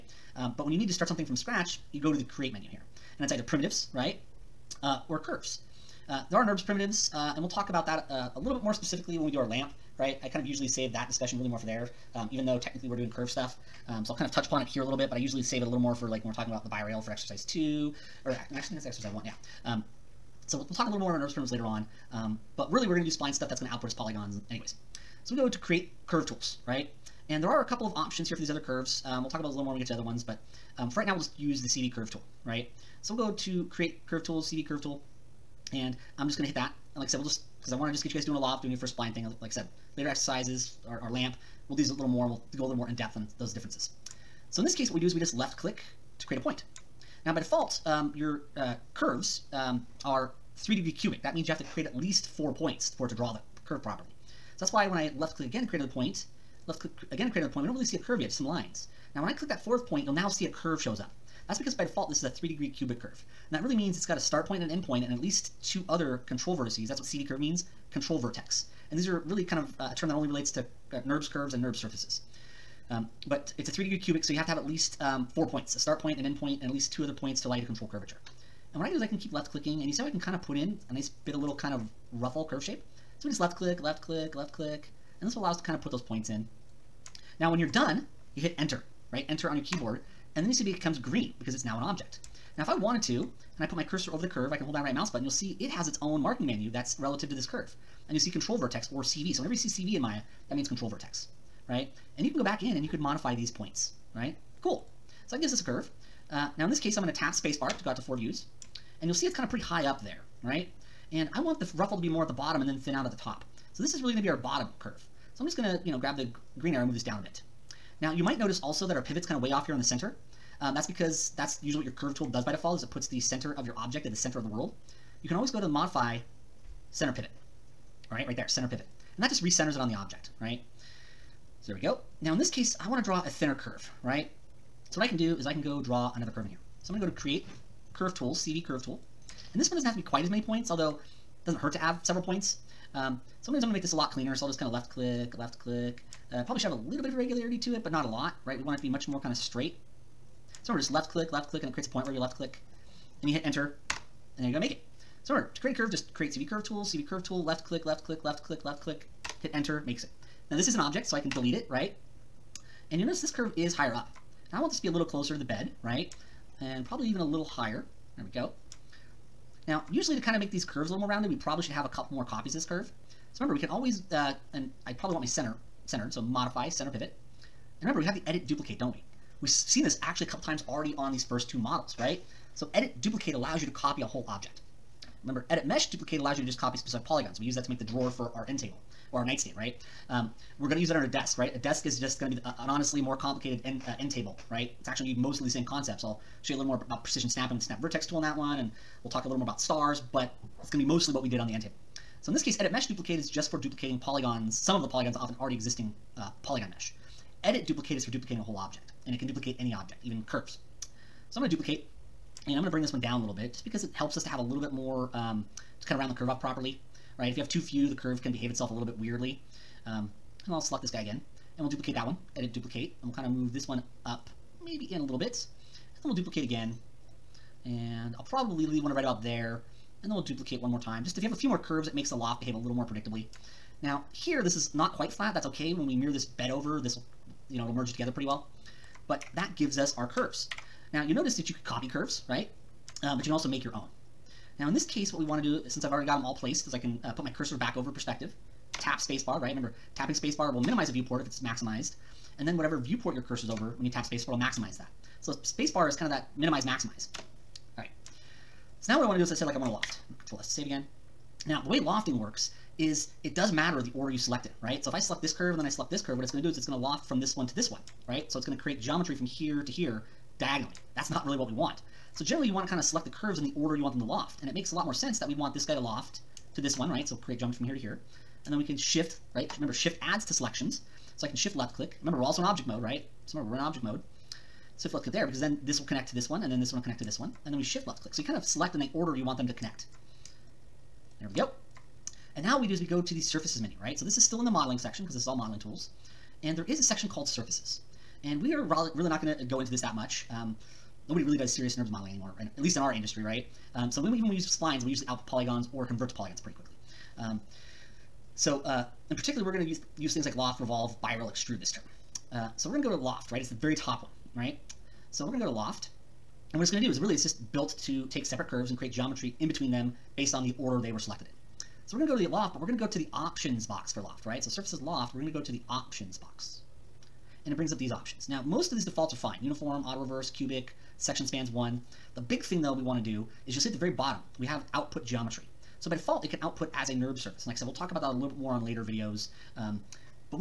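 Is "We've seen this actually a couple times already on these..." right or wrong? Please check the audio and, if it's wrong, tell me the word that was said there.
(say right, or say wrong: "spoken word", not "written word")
right.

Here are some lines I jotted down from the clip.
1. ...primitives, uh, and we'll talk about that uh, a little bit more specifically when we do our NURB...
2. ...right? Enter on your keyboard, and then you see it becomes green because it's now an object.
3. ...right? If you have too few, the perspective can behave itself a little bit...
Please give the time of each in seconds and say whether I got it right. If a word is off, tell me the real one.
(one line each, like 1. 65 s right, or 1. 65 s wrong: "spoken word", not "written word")
1. 6 s wrong: "LAMP", not "NURB"
2. 89 s right
3. 217 s wrong: "curve", not "perspective".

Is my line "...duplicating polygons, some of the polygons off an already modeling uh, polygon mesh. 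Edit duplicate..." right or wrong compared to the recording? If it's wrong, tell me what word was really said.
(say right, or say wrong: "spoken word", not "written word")
wrong: "existing", not "modeling".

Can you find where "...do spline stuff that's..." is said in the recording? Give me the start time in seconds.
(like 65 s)
23 s.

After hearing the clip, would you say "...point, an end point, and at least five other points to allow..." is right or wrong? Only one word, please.
wrong.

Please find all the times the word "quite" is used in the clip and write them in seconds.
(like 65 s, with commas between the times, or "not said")
140 s, 234 s.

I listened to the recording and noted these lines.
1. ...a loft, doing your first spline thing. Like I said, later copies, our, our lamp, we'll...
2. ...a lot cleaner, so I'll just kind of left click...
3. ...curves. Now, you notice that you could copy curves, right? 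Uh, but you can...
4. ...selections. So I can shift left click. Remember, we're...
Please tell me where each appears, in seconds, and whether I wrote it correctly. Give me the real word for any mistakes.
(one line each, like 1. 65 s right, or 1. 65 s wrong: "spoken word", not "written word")
1. 38 s wrong: "exercises", not "copies"
2. 143 s right
3. 240 s right
4. 280 s right.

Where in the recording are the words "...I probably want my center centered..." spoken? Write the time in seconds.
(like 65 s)
174 s.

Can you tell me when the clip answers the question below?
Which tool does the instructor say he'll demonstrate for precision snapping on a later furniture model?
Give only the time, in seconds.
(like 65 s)
197 s.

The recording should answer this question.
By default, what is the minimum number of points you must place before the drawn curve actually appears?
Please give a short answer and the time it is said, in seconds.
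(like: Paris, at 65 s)
4, at 51 s.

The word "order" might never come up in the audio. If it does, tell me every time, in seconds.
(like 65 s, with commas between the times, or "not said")
263 s, 273 s, 288 s, 320 s.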